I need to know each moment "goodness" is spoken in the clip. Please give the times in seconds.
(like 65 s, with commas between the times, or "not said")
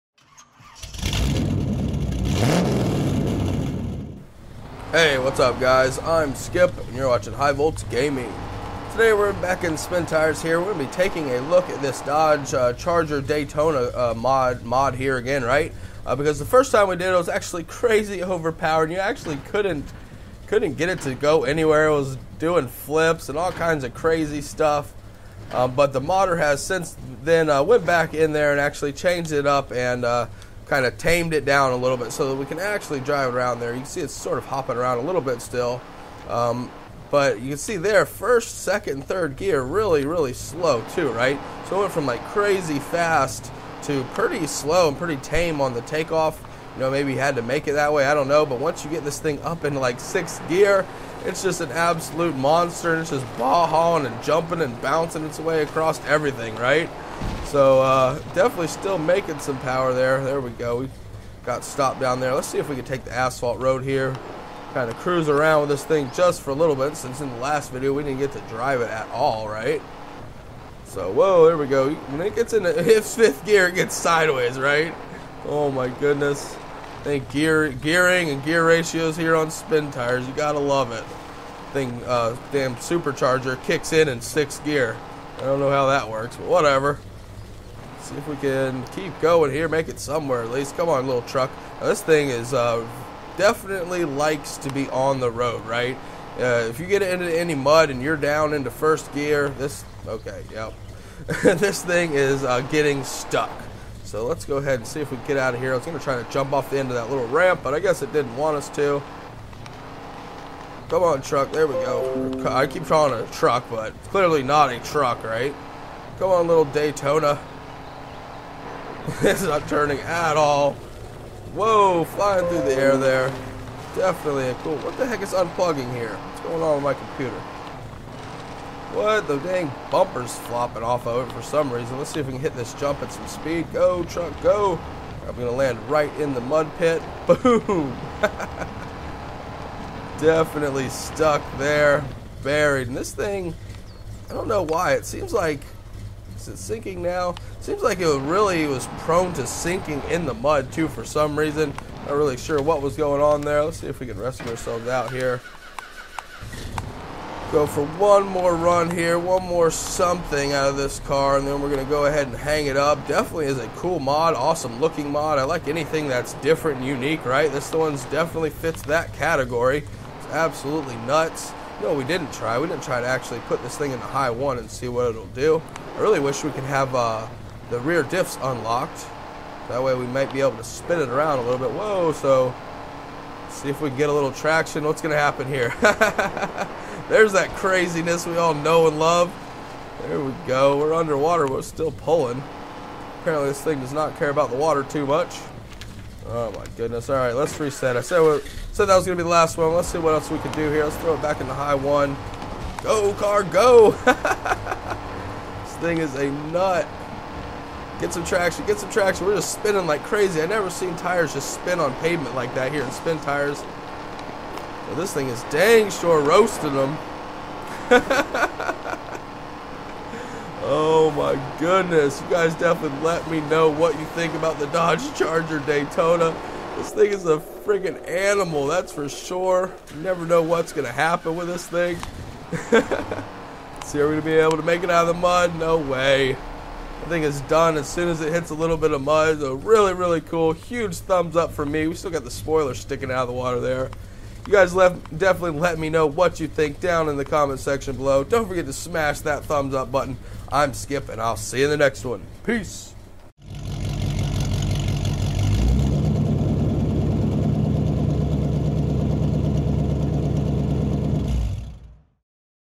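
75 s, 196 s, 221 s.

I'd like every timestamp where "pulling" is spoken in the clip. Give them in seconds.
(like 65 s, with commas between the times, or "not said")
191 s.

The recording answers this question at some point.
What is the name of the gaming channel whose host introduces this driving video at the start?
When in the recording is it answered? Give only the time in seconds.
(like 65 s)
7 s.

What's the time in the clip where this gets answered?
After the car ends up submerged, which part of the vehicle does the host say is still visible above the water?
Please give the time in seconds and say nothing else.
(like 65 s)
242 s.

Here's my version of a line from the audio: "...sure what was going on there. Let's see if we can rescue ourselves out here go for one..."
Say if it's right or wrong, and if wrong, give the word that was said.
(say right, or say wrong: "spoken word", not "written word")
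right.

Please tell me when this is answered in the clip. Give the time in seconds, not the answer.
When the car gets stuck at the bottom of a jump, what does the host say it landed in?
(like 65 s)
136 s.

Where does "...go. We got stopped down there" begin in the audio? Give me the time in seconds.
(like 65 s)
60 s.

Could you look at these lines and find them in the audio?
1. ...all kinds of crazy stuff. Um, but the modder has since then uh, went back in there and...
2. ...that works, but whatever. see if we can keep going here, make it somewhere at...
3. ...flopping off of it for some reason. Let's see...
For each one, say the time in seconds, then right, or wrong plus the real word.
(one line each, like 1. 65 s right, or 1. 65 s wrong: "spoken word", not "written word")
1. 23 s right
2. 85 s right
3. 130 s right.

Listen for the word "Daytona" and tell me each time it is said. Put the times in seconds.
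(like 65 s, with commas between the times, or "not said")
13 s, 116 s, 225 s.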